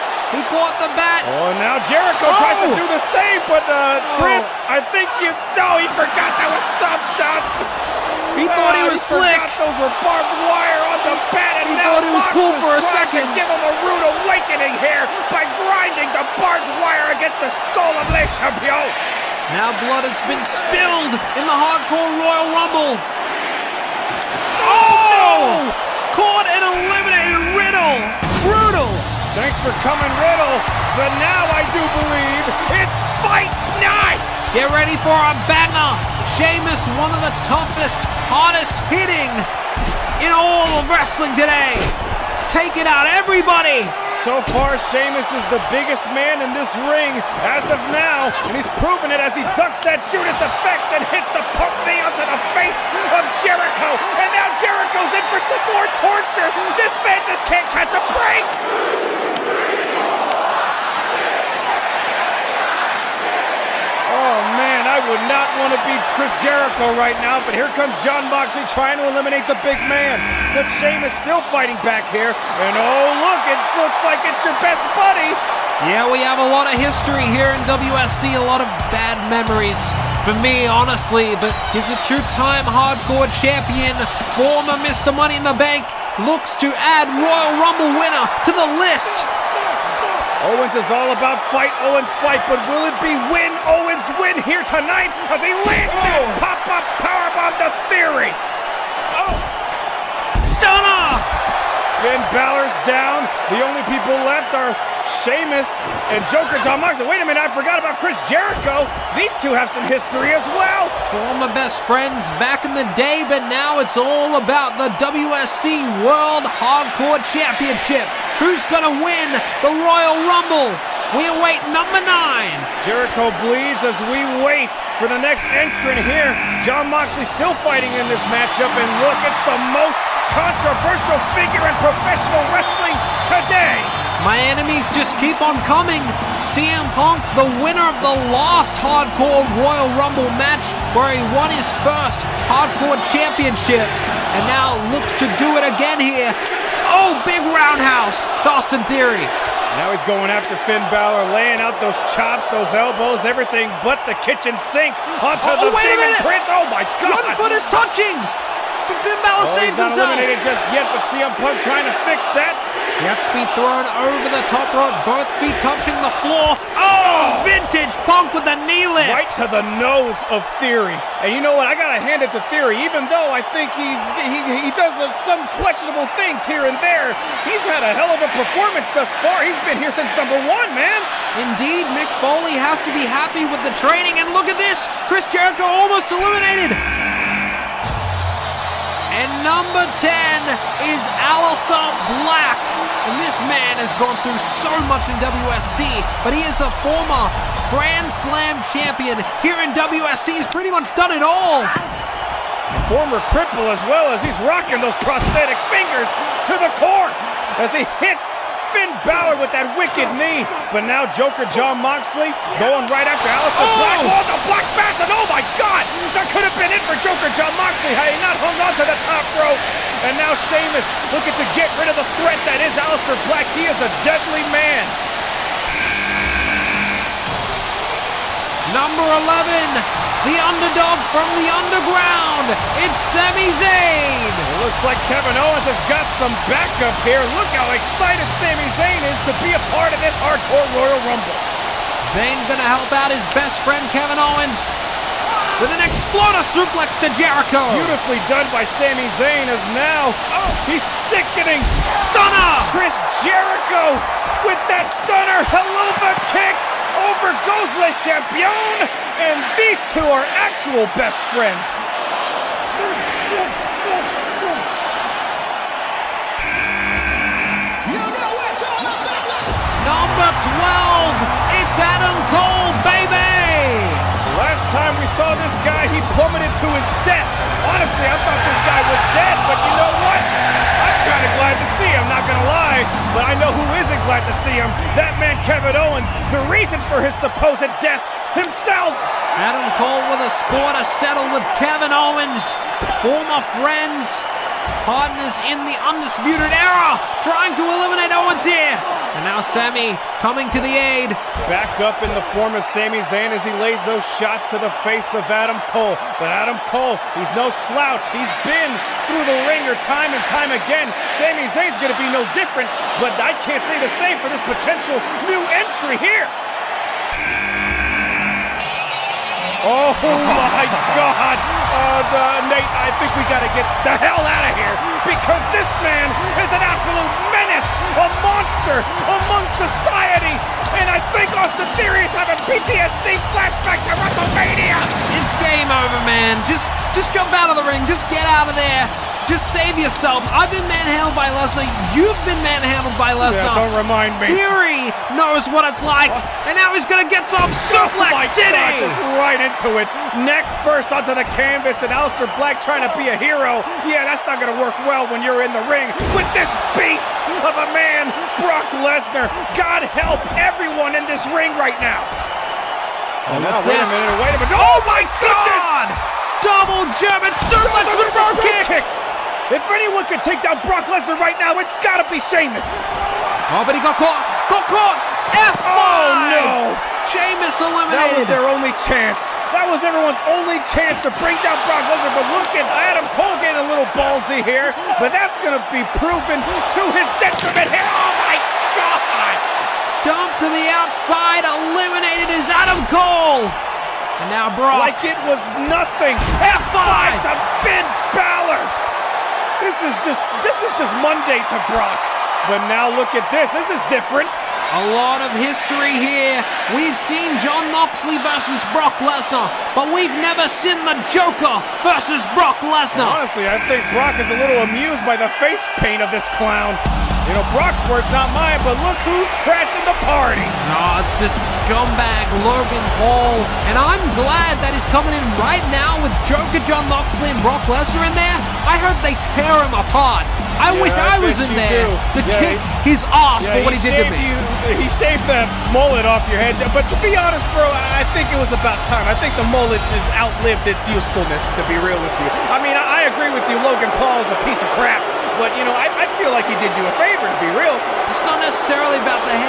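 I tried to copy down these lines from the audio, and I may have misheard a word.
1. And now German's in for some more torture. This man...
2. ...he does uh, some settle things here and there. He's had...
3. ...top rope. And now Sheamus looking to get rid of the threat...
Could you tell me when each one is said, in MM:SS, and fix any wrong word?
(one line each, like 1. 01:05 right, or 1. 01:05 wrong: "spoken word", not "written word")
1. 00:53 wrong: "Jericho", not "German"
2. 02:54 wrong: "questionable", not "settle"
3. 03:39 right.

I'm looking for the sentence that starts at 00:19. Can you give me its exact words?
Now blood has been spilled in the Hardcore Royal Rumble.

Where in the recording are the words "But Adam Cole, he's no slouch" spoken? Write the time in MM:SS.
05:06.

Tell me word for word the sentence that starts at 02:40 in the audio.
eliminated just yet, but CM Punk trying to fix that.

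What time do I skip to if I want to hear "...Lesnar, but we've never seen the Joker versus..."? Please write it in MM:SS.
06:49.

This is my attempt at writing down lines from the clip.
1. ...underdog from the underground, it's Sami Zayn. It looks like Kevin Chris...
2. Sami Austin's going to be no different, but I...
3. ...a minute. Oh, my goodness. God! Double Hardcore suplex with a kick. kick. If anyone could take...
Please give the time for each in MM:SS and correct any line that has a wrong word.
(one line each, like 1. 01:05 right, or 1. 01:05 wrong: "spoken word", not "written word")
1. 03:50 wrong: "Owens", not "Chris"
2. 05:11 wrong: "Zayn", not "Austin"
3. 06:04 wrong: "German", not "Hardcore".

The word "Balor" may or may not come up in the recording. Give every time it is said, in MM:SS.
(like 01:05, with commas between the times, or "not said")
01:42, 02:30, 02:39, 03:29, 06:38.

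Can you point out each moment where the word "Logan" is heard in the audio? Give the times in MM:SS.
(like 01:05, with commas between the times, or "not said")
07:02, 07:23.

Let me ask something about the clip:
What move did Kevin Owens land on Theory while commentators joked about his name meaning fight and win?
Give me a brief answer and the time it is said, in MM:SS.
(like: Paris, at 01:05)
pop-up powerbomb, at 01:36.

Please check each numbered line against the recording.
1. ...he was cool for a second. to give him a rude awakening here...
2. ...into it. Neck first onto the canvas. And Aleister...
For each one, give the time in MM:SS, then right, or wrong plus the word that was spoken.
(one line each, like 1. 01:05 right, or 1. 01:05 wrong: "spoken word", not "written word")
1. 00:12 right
2. 05:49 right.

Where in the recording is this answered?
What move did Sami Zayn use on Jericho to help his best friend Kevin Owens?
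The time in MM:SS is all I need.
04:05.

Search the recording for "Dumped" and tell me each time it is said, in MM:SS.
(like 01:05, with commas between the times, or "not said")
06:30.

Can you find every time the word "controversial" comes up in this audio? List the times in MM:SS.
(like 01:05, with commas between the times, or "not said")
02:10.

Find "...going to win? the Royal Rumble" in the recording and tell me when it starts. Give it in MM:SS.
01:58.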